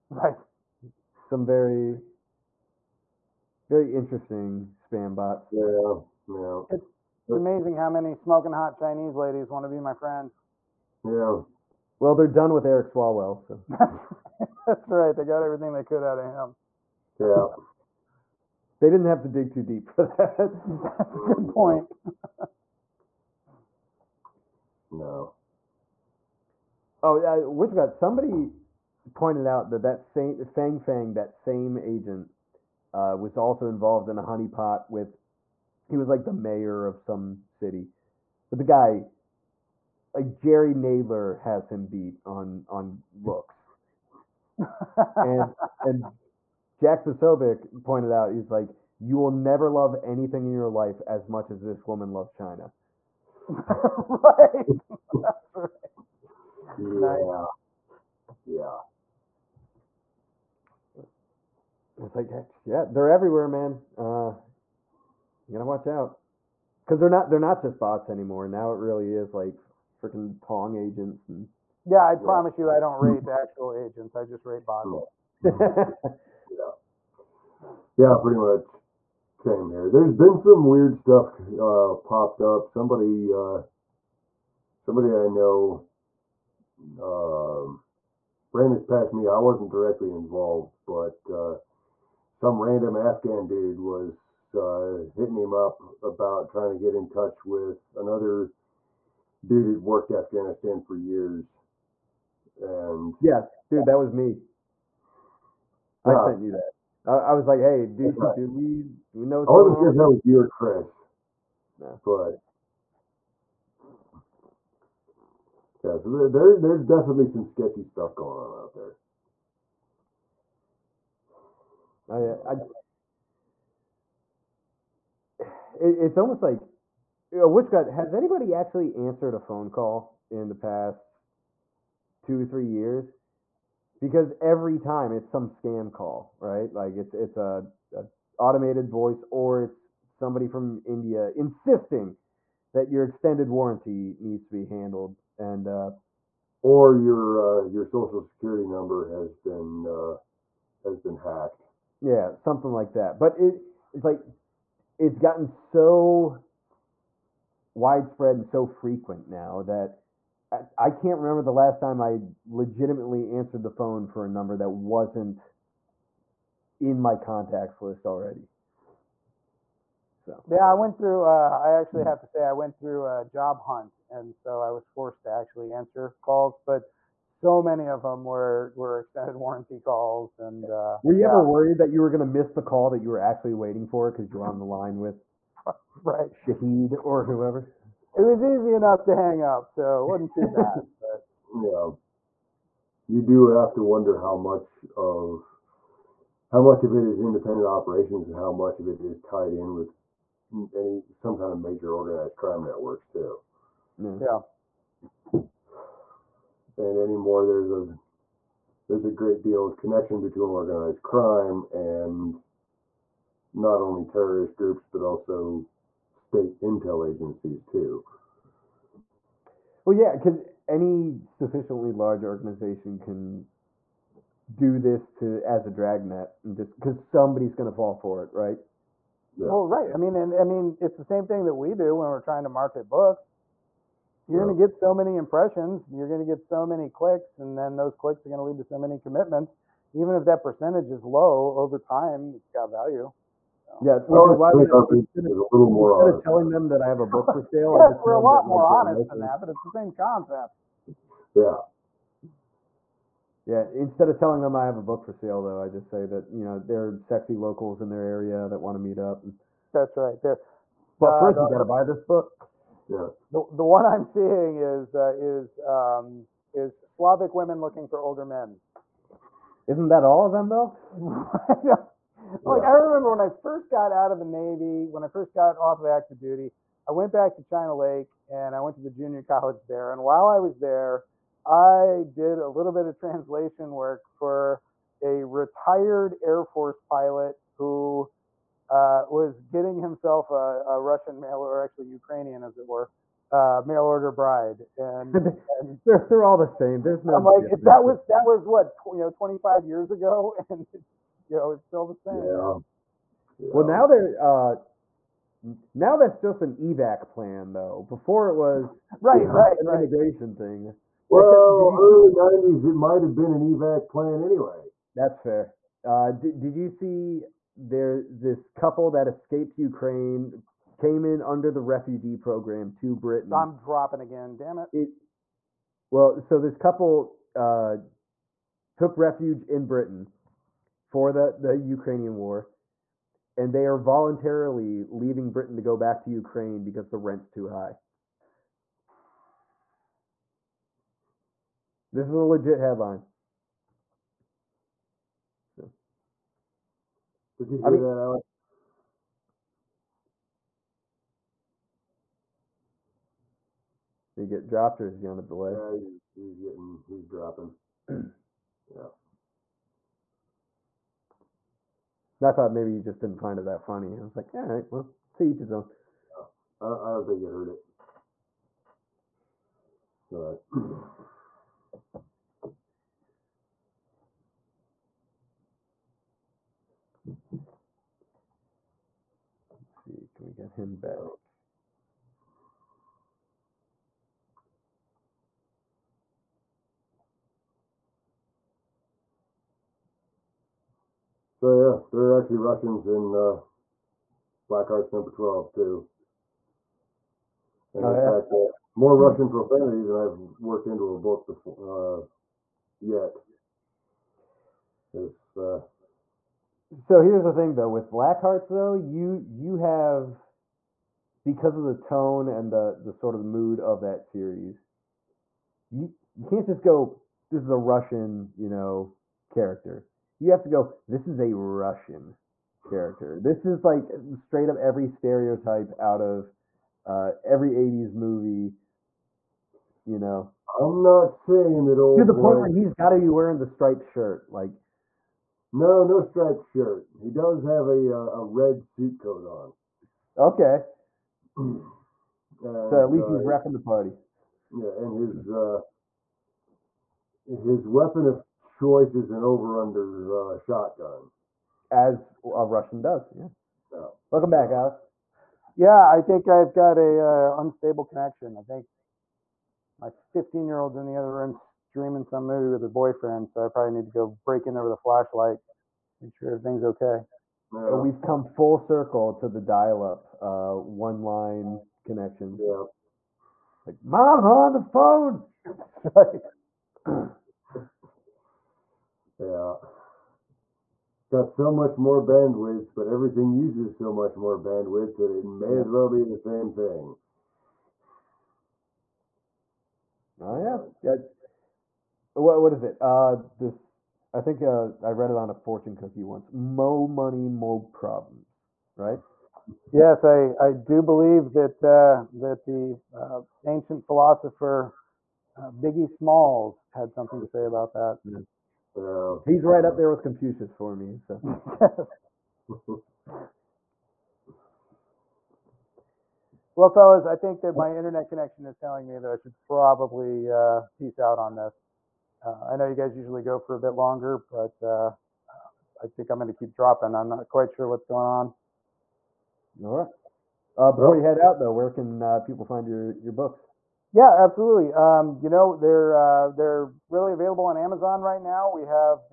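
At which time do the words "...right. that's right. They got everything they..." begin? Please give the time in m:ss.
0:14.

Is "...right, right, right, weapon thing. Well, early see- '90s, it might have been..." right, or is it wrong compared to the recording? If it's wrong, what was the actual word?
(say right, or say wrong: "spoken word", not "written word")
wrong: "immigration", not "weapon".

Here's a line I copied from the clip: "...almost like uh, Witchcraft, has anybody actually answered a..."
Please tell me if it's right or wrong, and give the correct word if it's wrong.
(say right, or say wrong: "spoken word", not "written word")
right.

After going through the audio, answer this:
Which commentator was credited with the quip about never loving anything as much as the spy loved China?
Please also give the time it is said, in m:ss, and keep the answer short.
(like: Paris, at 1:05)
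Jack Posobiec, at 0:46.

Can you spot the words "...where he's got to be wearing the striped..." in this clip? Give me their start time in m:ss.
7:12.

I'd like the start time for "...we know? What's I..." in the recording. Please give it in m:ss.
1:49.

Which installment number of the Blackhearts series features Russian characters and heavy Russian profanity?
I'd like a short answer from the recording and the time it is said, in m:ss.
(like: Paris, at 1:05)
12, at 6:35.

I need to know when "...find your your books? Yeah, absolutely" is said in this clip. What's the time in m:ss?
8:52.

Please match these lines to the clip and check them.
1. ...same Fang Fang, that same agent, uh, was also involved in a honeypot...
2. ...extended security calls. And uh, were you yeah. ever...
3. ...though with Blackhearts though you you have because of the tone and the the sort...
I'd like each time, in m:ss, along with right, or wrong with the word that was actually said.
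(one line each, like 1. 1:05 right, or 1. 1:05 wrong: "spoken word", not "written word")
1. 0:30 right
2. 2:58 wrong: "warranty", not "security"
3. 6:47 right.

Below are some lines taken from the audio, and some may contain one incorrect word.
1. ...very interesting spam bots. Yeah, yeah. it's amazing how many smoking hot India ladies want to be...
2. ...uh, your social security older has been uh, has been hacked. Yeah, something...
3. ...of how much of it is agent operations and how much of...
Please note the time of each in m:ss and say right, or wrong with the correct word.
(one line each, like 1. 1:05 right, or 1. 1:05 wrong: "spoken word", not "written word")
1. 0:03 wrong: "Chinese", not "India"
2. 2:27 wrong: "number", not "older"
3. 3:14 wrong: "independent", not "agent".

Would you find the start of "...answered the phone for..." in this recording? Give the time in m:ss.
2:43.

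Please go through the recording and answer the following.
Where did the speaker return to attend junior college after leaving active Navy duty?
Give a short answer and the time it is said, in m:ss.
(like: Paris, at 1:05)
China Lake, at 4:37.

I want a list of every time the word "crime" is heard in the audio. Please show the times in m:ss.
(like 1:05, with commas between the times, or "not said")
3:22, 3:31.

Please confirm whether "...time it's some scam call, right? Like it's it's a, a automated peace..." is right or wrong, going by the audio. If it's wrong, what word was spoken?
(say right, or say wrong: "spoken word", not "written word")
wrong: "voice", not "peace".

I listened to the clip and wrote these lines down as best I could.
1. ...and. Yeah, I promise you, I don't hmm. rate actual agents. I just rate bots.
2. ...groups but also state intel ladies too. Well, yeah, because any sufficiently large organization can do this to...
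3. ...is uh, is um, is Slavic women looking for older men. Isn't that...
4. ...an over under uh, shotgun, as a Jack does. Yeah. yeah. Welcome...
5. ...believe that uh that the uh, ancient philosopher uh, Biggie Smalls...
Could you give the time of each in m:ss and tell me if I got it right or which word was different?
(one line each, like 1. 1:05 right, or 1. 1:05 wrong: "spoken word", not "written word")
1. 1:11 right
2. 3:34 wrong: "agencies", not "ladies"
3. 4:24 right
4. 7:29 wrong: "Russian", not "Jack"
5. 8:20 right.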